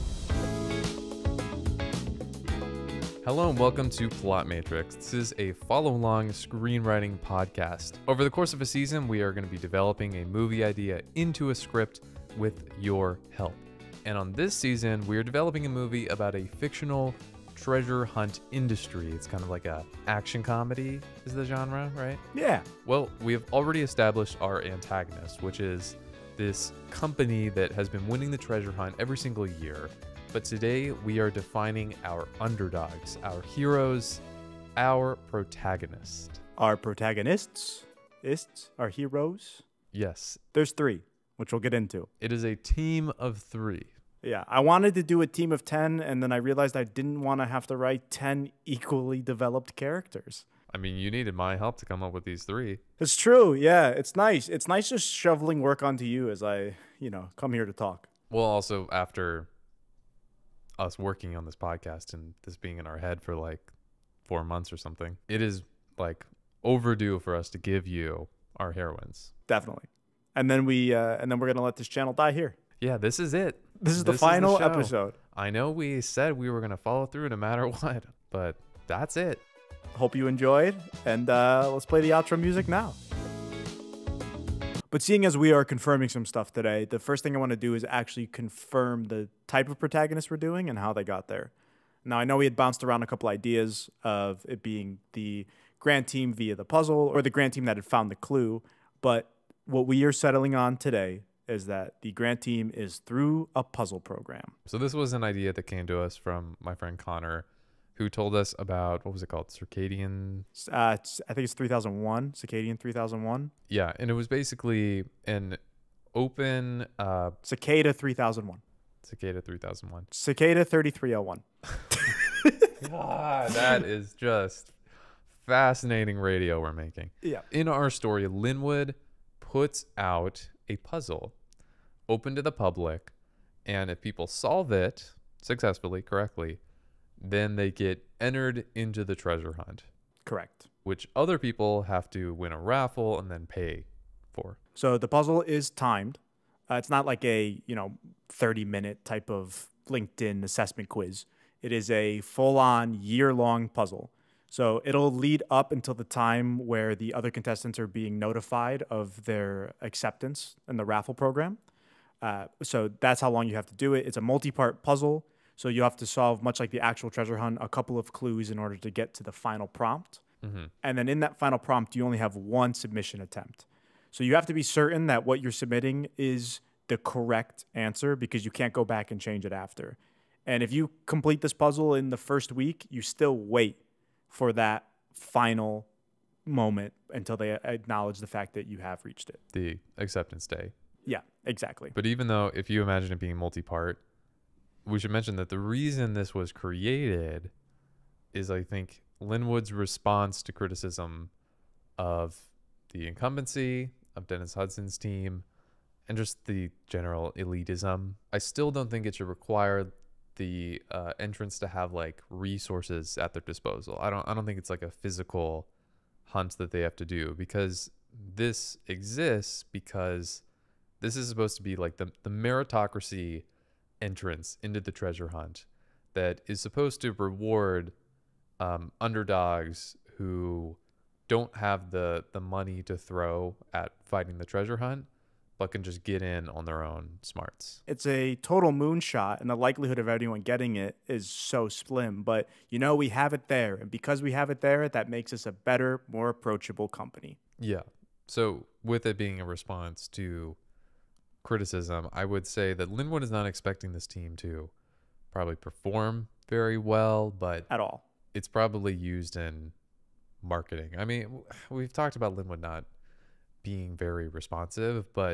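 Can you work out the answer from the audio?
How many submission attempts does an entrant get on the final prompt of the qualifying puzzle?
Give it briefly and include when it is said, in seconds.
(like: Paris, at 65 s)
1, at 172 s.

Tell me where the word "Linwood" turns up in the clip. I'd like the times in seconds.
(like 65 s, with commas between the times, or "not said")
128 s, 199 s, 252 s, 262 s.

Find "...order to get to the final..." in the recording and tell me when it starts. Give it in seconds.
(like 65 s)
168 s.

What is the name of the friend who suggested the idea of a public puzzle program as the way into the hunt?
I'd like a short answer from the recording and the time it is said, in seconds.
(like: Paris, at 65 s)
Connor, at 106 s.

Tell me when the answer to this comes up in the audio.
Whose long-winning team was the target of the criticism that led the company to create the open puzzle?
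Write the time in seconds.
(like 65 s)
204 s.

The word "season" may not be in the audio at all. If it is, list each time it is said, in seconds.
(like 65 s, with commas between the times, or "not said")
8 s, 14 s.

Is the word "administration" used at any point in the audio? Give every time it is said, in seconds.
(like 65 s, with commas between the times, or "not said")
not said.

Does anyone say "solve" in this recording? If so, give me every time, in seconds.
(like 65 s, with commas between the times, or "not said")
134 s, 166 s.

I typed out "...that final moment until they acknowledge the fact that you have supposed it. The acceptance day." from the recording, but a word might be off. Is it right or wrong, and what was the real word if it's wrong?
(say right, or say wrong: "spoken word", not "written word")
wrong: "reached", not "supposed".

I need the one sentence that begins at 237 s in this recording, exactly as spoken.
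It's a total moonshot, and the likelihood of anyone getting it is so slim.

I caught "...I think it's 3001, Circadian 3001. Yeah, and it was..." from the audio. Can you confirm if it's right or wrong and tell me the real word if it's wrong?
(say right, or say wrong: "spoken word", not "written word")
right.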